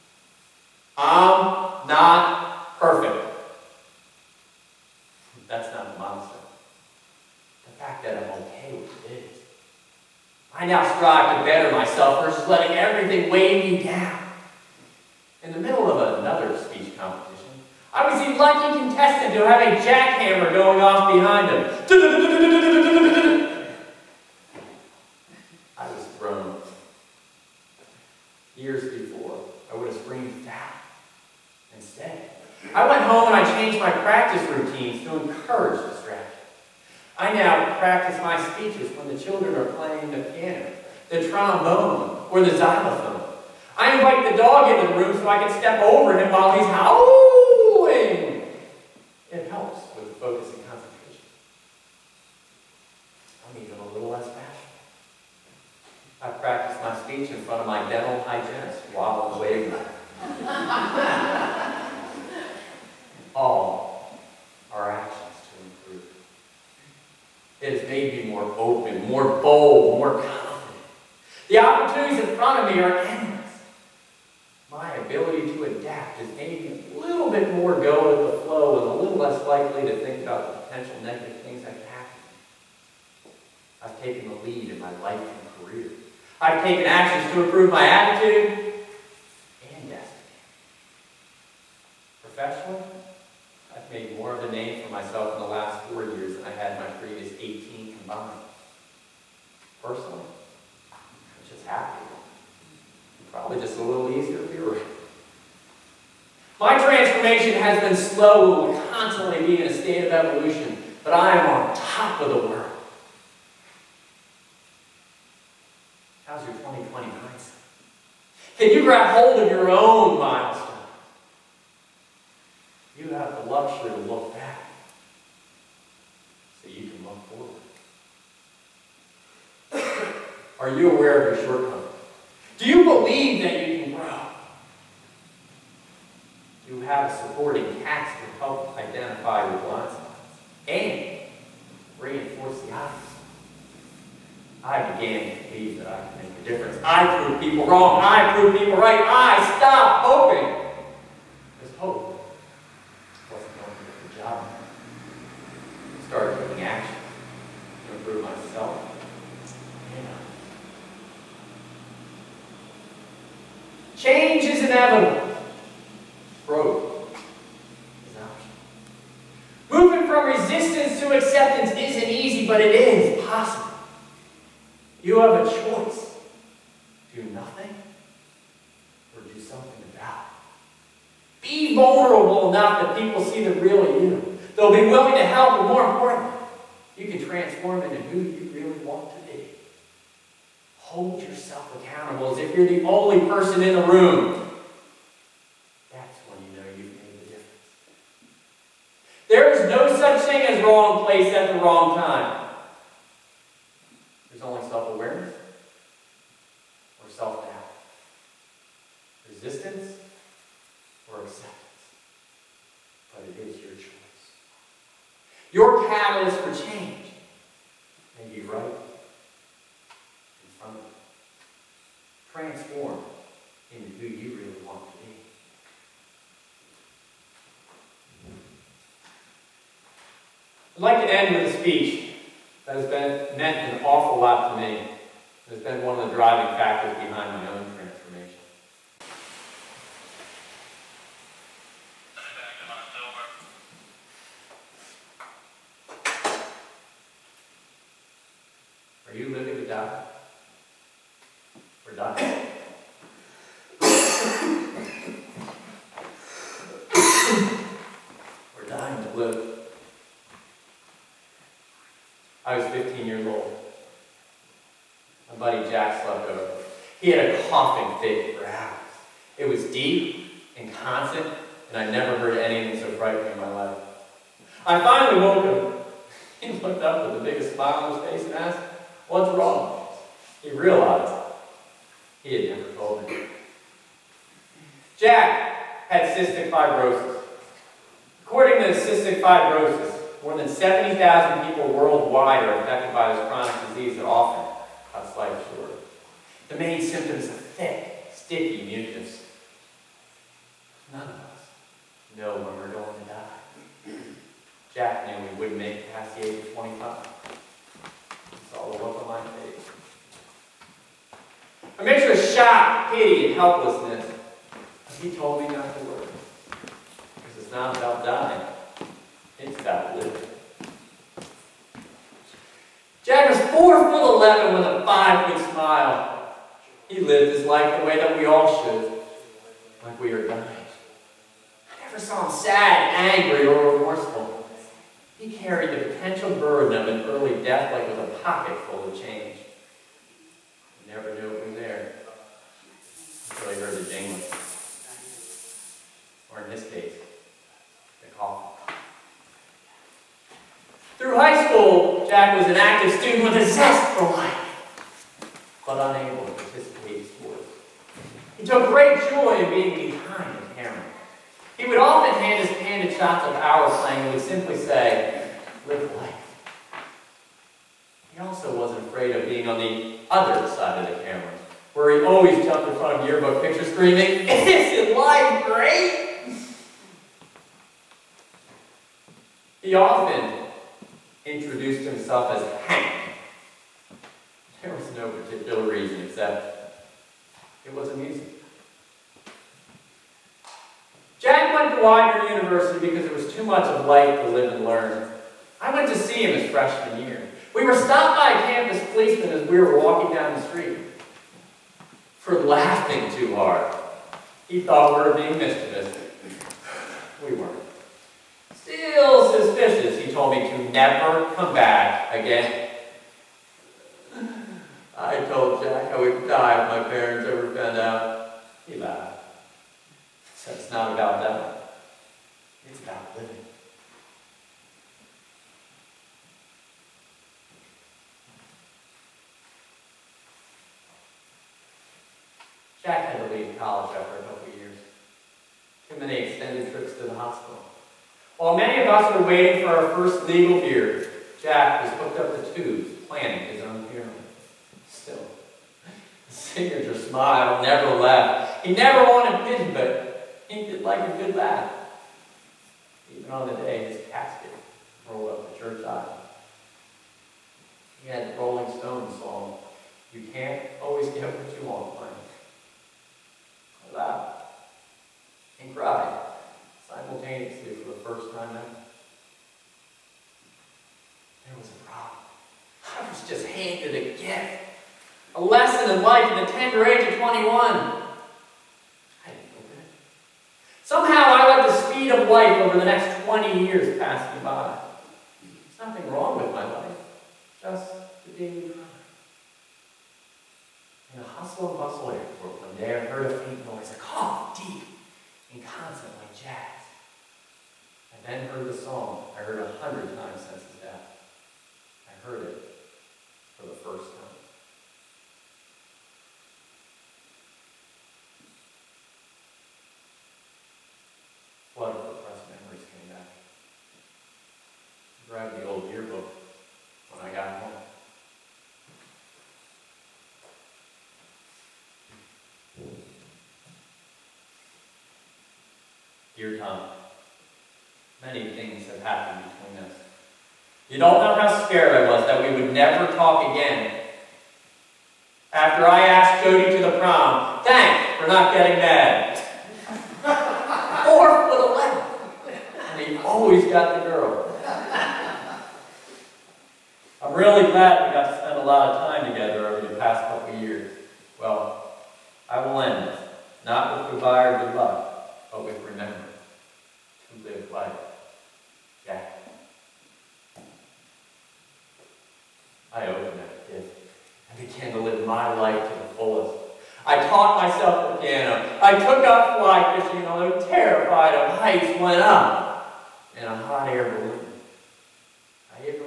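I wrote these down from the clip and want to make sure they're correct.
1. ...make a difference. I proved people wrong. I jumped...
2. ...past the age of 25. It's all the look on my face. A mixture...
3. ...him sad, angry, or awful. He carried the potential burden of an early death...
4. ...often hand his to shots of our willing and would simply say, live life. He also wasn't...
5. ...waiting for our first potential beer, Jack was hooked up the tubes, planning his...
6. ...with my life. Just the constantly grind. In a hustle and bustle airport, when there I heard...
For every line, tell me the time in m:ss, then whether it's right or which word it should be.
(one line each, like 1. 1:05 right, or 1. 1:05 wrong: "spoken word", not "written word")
1. 2:26 wrong: "proved", not "jumped"
2. 5:05 right
3. 5:32 wrong: "remorseful", not "awful"
4. 6:01 wrong: "playing", not "willing"
5. 7:19 wrong: "legal", not "potential"
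6. 8:06 wrong: "daily", not "constantly".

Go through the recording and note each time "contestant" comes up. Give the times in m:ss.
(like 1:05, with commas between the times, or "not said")
0:18.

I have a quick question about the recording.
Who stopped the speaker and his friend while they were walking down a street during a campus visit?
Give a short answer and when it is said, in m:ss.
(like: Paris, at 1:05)
campus policeman, at 6:38.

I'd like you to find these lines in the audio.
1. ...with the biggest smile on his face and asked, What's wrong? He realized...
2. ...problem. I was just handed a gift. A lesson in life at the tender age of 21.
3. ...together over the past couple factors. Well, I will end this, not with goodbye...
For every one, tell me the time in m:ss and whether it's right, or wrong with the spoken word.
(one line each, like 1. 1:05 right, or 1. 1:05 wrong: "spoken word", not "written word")
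1. 4:37 right
2. 7:51 right
3. 9:09 wrong: "years", not "factors".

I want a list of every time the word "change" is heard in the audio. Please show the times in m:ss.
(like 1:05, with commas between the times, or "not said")
2:43, 5:38.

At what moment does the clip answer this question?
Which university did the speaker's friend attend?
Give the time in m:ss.
6:31.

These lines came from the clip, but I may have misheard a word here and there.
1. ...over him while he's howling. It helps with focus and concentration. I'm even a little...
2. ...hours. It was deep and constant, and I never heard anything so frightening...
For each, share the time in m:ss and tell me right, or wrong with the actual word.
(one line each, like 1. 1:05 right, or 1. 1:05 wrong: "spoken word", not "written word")
1. 0:45 right
2. 4:28 right.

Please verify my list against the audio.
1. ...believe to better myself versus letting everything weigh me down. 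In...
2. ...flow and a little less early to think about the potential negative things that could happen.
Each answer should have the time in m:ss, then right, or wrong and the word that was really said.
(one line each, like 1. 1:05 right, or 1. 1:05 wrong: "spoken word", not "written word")
1. 0:10 wrong: "strive", not "believe"
2. 1:18 wrong: "likely", not "early".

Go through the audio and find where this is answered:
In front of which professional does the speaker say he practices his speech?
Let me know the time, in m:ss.
0:57.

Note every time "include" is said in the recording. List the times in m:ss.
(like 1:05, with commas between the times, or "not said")
not said.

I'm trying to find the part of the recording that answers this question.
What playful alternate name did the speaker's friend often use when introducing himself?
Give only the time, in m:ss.
6:22.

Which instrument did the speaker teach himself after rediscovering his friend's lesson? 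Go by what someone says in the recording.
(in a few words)
piano.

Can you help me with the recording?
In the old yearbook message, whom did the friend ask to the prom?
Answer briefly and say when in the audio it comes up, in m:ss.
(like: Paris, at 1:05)
Jody, at 8:56.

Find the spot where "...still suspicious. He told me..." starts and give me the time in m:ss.
6:48.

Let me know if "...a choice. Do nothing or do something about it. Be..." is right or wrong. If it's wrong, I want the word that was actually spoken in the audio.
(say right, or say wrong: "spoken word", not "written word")
right.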